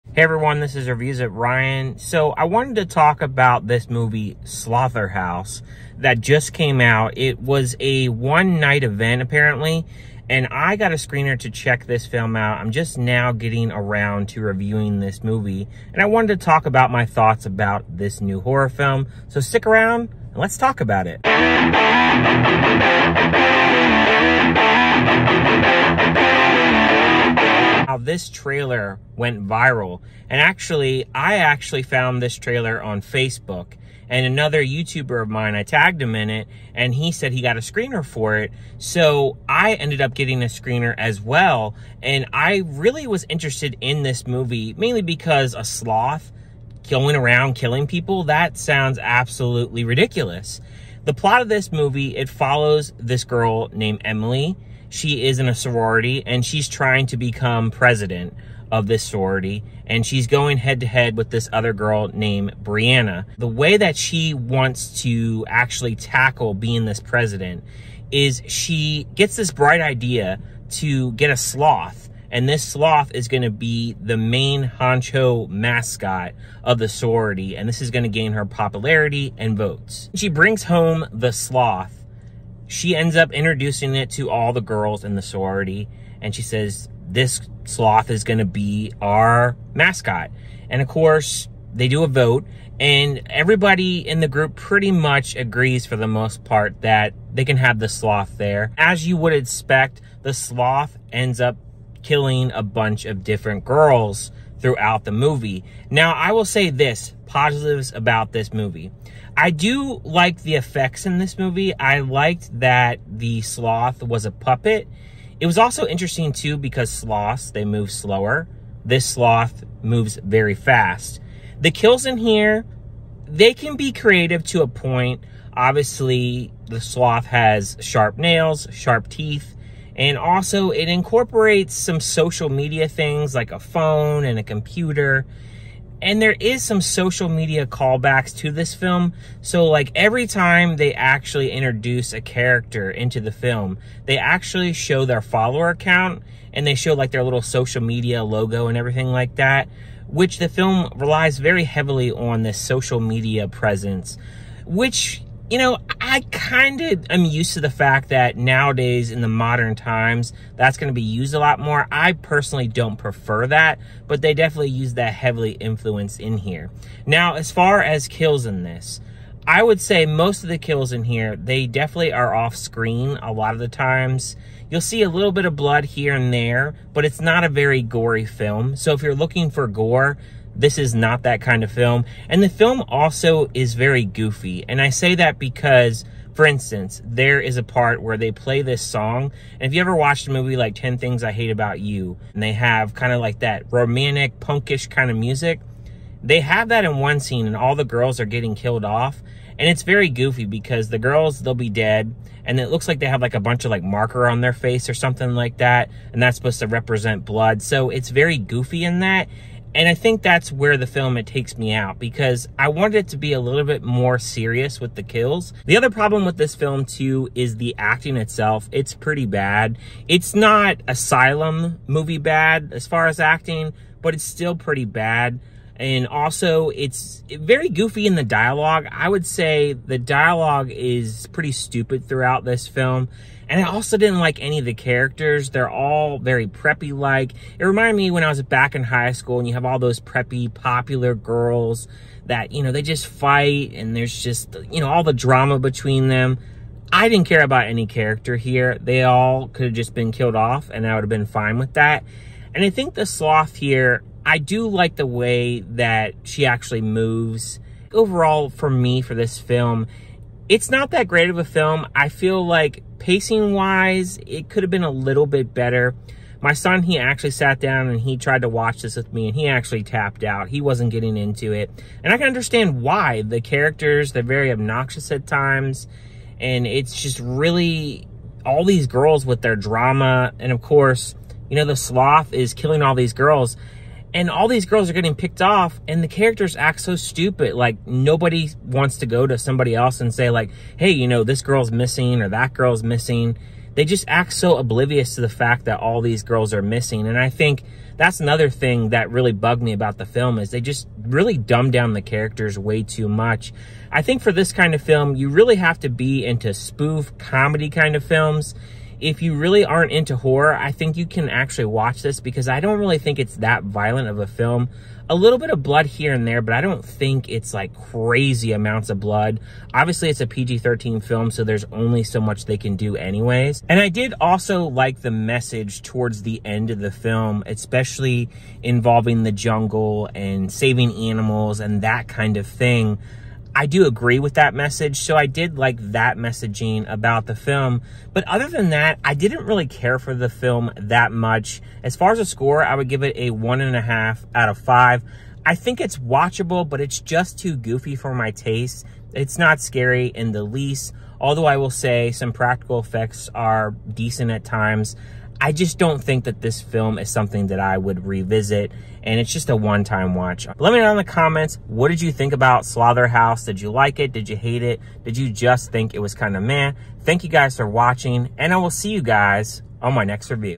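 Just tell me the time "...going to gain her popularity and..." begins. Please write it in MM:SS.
01:17.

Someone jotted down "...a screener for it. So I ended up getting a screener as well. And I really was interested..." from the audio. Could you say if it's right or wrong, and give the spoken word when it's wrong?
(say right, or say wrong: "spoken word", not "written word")
right.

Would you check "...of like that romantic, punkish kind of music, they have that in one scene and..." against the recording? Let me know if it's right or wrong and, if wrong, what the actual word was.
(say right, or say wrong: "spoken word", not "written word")
right.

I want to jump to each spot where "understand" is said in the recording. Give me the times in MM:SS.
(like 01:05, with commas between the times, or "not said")
04:32.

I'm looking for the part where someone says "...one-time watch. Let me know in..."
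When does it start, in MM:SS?
05:59.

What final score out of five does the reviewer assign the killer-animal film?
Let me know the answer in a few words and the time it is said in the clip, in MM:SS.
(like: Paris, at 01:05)
1.5, at 05:43.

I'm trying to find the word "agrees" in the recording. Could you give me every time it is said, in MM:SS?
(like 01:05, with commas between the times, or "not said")
01:35, 05:33.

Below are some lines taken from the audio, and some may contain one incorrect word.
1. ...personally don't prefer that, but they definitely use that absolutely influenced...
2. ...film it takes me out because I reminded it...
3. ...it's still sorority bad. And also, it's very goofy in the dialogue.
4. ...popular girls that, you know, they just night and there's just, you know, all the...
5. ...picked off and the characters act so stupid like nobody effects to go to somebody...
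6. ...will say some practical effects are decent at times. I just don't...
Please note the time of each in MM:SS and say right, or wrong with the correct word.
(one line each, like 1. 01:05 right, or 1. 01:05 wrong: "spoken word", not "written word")
1. 02:42 wrong: "heavily", not "absolutely"
2. 03:30 wrong: "wanted", not "reminded"
3. 03:44 wrong: "pretty", not "sorority"
4. 04:00 wrong: "fight", not "night"
5. 04:45 wrong: "wants", not "effects"
6. 05:51 right.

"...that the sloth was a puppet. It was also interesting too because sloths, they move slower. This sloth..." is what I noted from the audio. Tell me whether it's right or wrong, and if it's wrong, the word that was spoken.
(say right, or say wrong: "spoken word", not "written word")
right.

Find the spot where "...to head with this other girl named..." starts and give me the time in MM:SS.
01:00.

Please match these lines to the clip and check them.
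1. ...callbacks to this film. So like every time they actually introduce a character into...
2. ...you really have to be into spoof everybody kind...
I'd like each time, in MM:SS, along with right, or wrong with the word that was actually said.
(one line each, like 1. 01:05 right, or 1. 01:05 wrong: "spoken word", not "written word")
1. 02:17 right
2. 05:05 wrong: "comedy", not "everybody".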